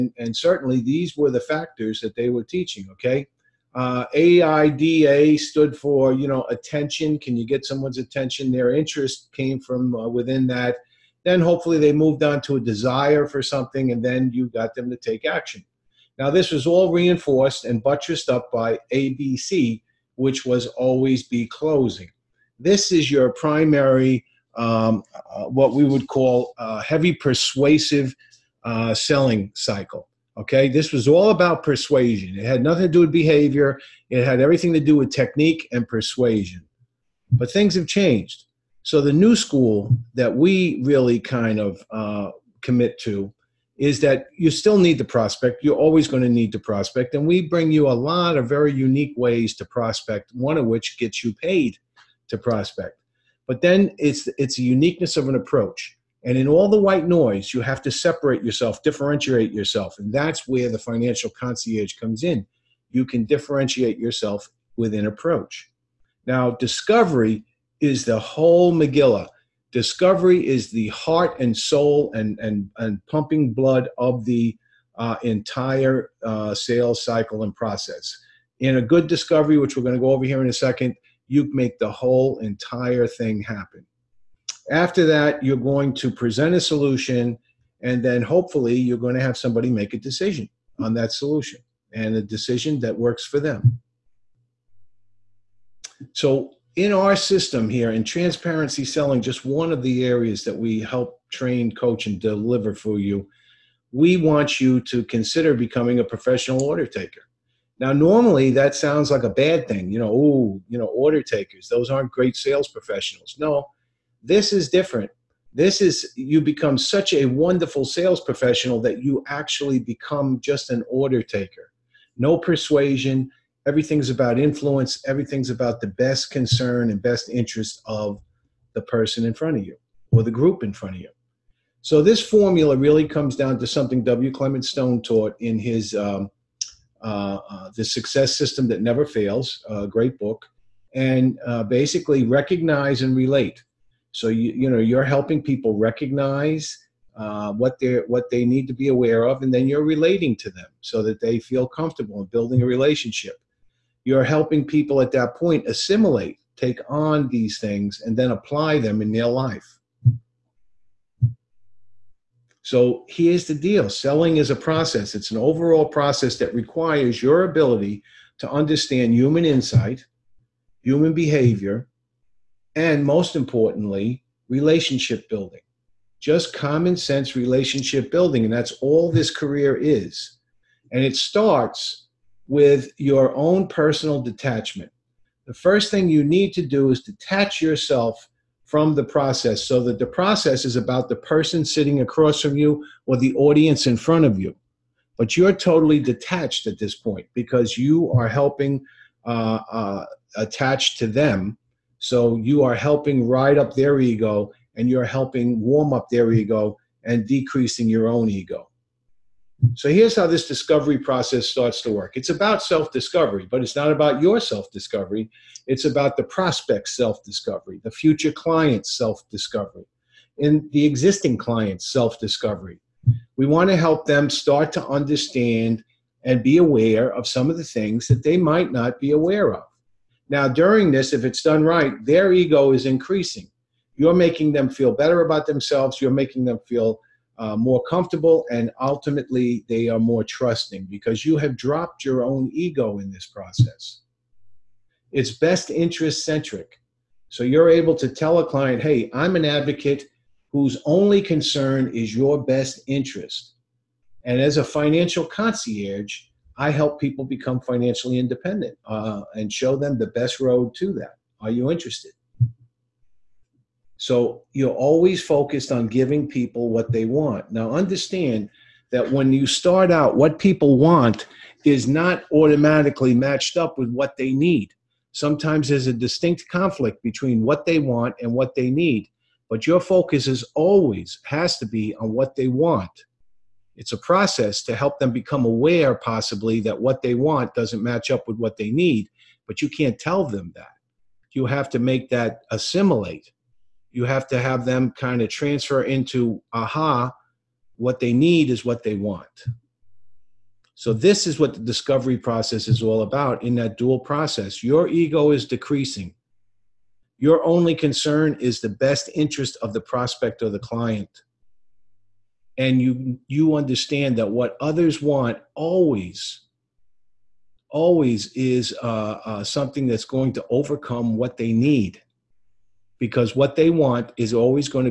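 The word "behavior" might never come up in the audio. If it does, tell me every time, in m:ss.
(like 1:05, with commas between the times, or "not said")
0:33, 2:51.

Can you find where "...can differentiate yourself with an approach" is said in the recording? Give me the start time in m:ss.
1:03.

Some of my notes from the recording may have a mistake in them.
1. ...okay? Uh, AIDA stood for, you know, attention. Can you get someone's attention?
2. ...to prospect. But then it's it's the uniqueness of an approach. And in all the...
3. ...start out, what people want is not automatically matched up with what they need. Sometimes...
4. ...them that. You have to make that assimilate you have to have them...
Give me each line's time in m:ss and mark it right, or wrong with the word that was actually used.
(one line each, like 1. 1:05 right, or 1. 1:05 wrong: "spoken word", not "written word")
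1. 0:02 right
2. 0:52 right
3. 4:29 right
4. 4:50 right.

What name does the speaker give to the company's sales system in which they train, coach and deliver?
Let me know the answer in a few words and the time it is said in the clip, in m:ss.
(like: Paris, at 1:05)
Transparency selling, at 1:38.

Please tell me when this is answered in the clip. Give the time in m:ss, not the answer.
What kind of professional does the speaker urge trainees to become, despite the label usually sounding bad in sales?
1:46.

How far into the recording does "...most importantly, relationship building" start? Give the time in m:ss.
2:53.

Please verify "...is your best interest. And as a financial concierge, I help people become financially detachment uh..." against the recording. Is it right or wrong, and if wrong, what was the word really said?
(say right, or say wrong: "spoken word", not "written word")
wrong: "independent", not "detachment".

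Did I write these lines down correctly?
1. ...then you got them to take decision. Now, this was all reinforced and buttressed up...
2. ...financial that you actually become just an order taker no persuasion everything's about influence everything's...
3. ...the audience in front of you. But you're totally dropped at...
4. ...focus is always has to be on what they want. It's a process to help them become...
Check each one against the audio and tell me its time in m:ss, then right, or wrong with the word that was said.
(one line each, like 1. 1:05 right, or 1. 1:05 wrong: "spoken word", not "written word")
1. 0:14 wrong: "action", not "decision"
2. 1:58 wrong: "professional", not "financial"
3. 3:13 wrong: "detached", not "dropped"
4. 4:39 right.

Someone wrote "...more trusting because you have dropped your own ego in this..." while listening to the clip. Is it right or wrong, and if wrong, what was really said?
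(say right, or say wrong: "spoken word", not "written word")
right.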